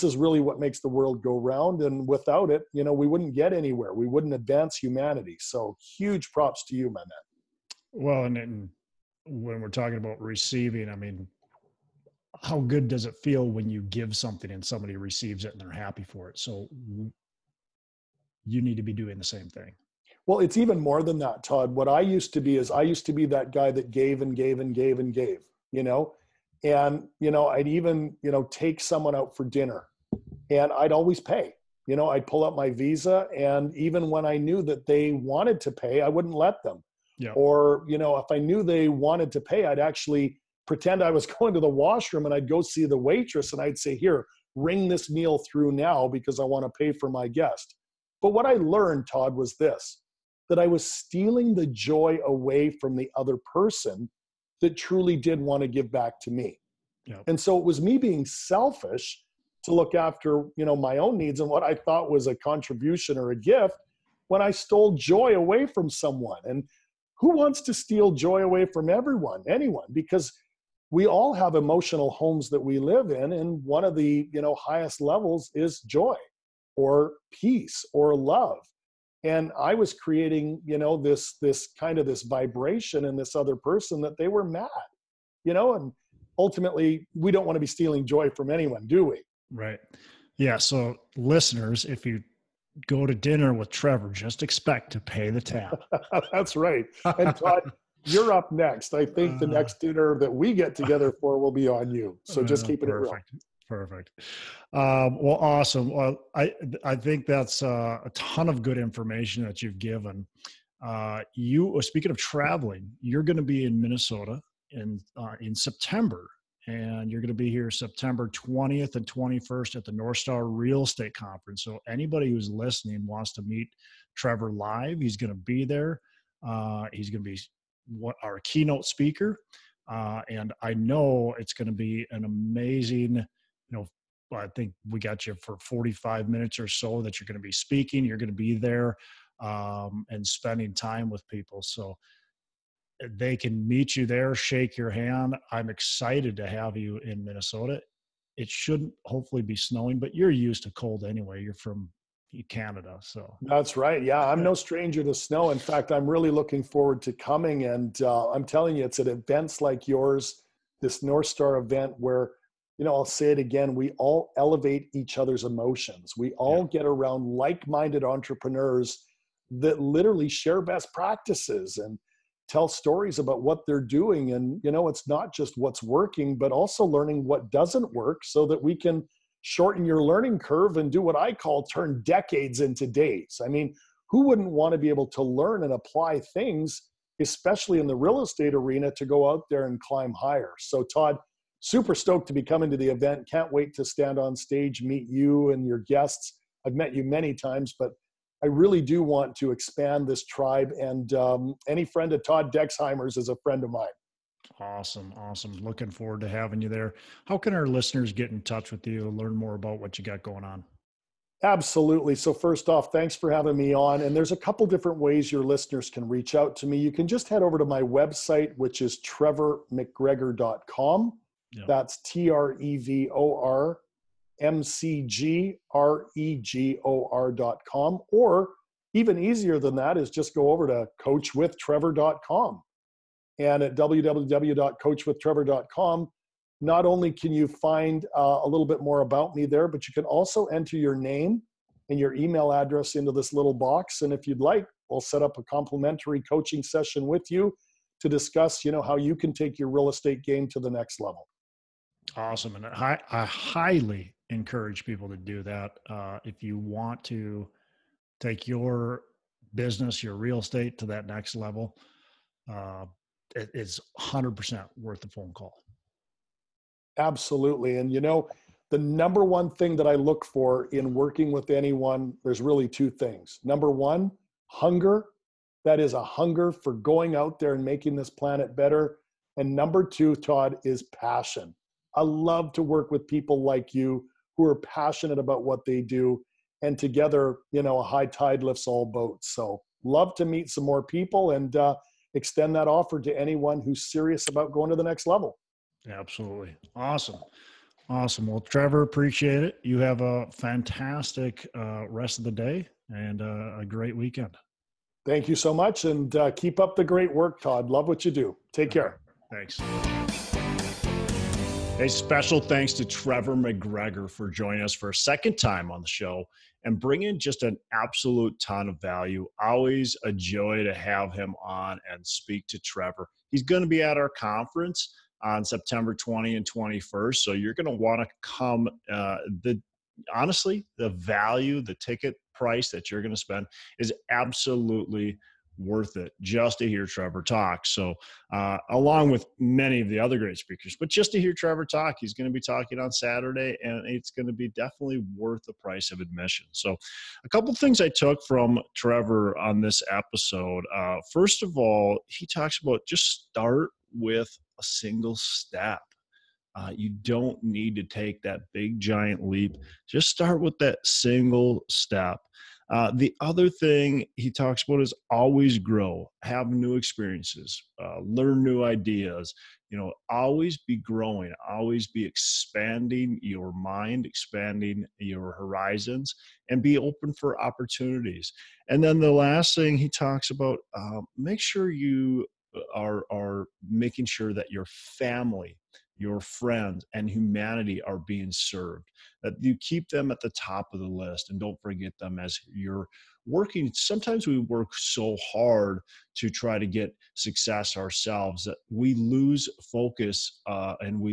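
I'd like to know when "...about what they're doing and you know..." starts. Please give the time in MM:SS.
02:53.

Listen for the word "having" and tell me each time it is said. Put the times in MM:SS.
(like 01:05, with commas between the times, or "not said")
03:26, 03:33.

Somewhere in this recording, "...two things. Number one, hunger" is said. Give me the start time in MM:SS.
04:32.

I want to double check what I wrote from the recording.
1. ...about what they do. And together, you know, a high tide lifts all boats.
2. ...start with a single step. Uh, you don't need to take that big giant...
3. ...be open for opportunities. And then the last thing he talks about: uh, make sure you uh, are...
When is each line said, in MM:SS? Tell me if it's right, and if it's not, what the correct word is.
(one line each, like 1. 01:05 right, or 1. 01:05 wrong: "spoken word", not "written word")
1. 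04:45 right
2. 05:53 right
3. 06:16 right.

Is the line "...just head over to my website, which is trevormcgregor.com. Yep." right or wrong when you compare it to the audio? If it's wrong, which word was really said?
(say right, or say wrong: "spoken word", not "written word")
right.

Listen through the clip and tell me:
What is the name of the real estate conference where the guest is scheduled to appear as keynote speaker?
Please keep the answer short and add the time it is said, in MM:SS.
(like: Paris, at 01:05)
Northstar Real Estate Conference, at 01:59.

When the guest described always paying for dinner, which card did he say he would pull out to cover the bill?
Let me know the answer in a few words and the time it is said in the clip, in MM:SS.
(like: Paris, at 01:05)
Visa, at 00:32.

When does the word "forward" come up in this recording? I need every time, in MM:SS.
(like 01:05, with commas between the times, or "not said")
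02:36, 03:25.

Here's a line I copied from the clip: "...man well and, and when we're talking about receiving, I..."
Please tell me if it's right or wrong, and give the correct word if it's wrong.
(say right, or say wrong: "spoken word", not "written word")
right.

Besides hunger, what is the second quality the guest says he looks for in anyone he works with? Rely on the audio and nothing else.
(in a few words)
passion.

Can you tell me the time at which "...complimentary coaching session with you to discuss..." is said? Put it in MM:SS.
04:05.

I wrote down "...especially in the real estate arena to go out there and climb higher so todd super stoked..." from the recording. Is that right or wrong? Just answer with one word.
right.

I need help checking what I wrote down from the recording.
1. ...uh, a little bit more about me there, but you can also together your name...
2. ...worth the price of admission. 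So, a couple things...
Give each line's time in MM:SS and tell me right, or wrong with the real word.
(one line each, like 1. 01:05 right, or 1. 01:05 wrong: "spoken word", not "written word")
1. 03:58 wrong: "enter", not "together"
2. 05:45 right.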